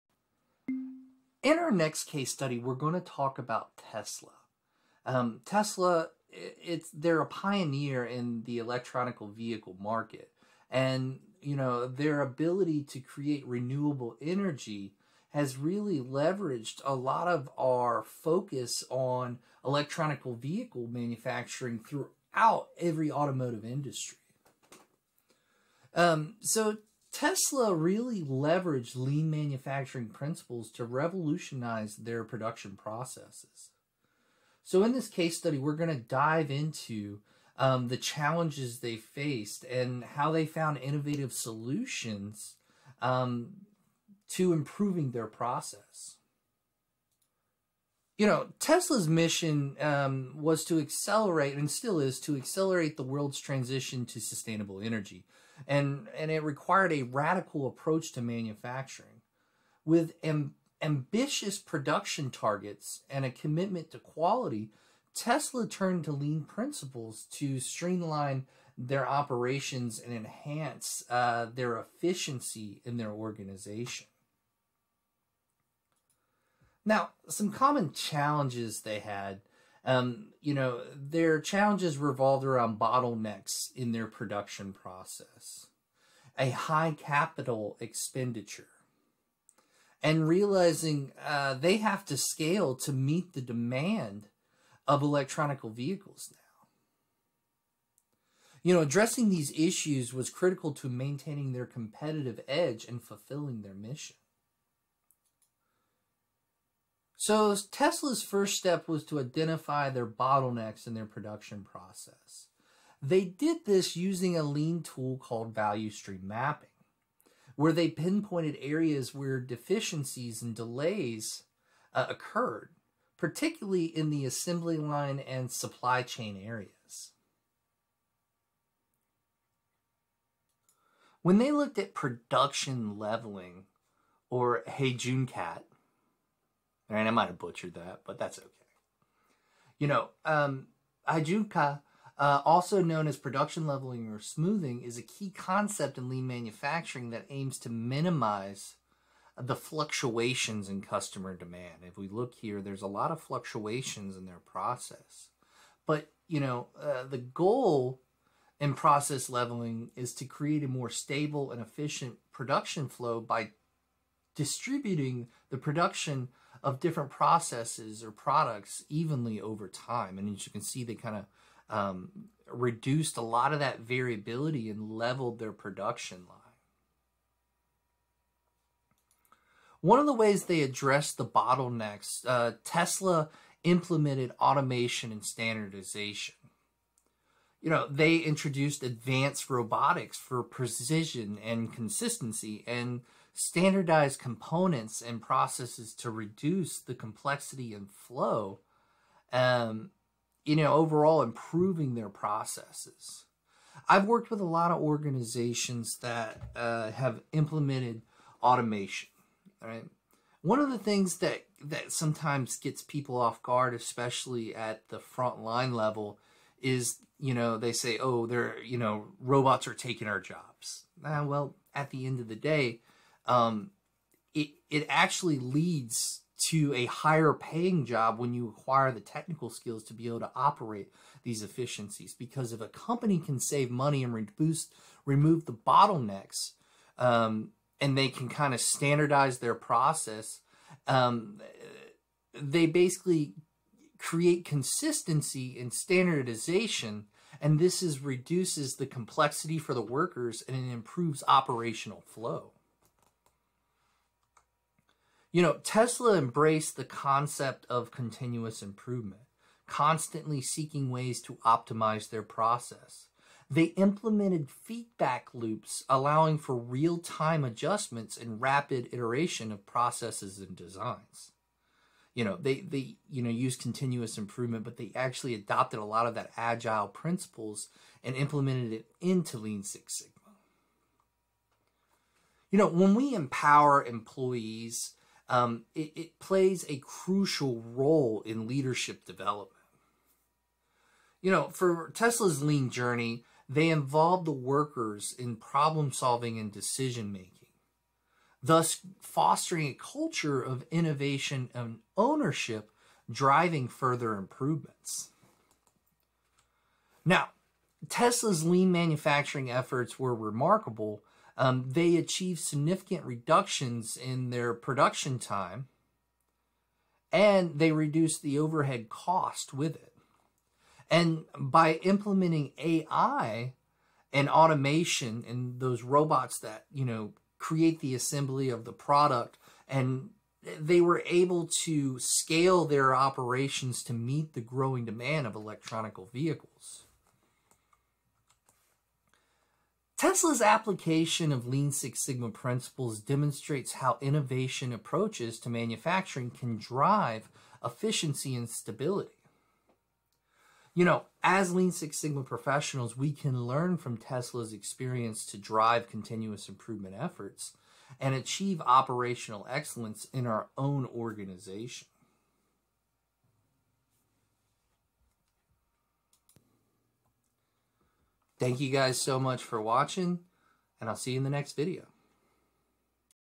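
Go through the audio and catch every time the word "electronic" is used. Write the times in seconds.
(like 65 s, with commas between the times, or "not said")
8 s, 19 s, 95 s, 335 s.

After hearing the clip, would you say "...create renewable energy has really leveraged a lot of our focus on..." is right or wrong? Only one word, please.
right.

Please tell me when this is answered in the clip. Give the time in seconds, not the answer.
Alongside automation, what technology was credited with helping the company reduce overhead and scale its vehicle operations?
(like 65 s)
322 s.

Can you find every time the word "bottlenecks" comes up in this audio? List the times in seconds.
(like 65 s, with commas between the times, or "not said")
82 s, 110 s, 181 s, 235 s.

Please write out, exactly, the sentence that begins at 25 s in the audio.
Um, so Tesla really leveraged lean manufacturing principles to revolutionize their production processes.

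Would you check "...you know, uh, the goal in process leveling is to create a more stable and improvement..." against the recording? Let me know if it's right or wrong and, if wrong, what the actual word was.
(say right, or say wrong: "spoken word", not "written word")
wrong: "efficient", not "improvement".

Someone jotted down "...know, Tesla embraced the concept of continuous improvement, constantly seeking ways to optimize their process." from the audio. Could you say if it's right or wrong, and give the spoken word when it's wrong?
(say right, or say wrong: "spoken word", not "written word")
right.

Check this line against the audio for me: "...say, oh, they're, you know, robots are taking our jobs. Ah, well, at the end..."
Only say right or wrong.
right.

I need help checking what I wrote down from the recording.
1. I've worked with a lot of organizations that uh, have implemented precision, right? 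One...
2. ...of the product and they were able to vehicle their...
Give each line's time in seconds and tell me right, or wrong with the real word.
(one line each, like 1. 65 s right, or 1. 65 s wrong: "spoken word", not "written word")
1. 203 s wrong: "automation", not "precision"
2. 328 s wrong: "scale", not "vehicle".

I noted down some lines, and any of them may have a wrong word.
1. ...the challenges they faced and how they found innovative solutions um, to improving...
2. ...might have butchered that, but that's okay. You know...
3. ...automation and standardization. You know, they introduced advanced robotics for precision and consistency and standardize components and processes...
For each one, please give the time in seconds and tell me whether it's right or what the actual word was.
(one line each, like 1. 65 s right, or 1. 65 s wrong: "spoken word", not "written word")
1. 37 s right
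2. 137 s right
3. 184 s right.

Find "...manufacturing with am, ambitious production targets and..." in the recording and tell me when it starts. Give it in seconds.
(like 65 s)
58 s.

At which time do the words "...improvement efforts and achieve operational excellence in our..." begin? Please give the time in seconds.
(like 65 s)
356 s.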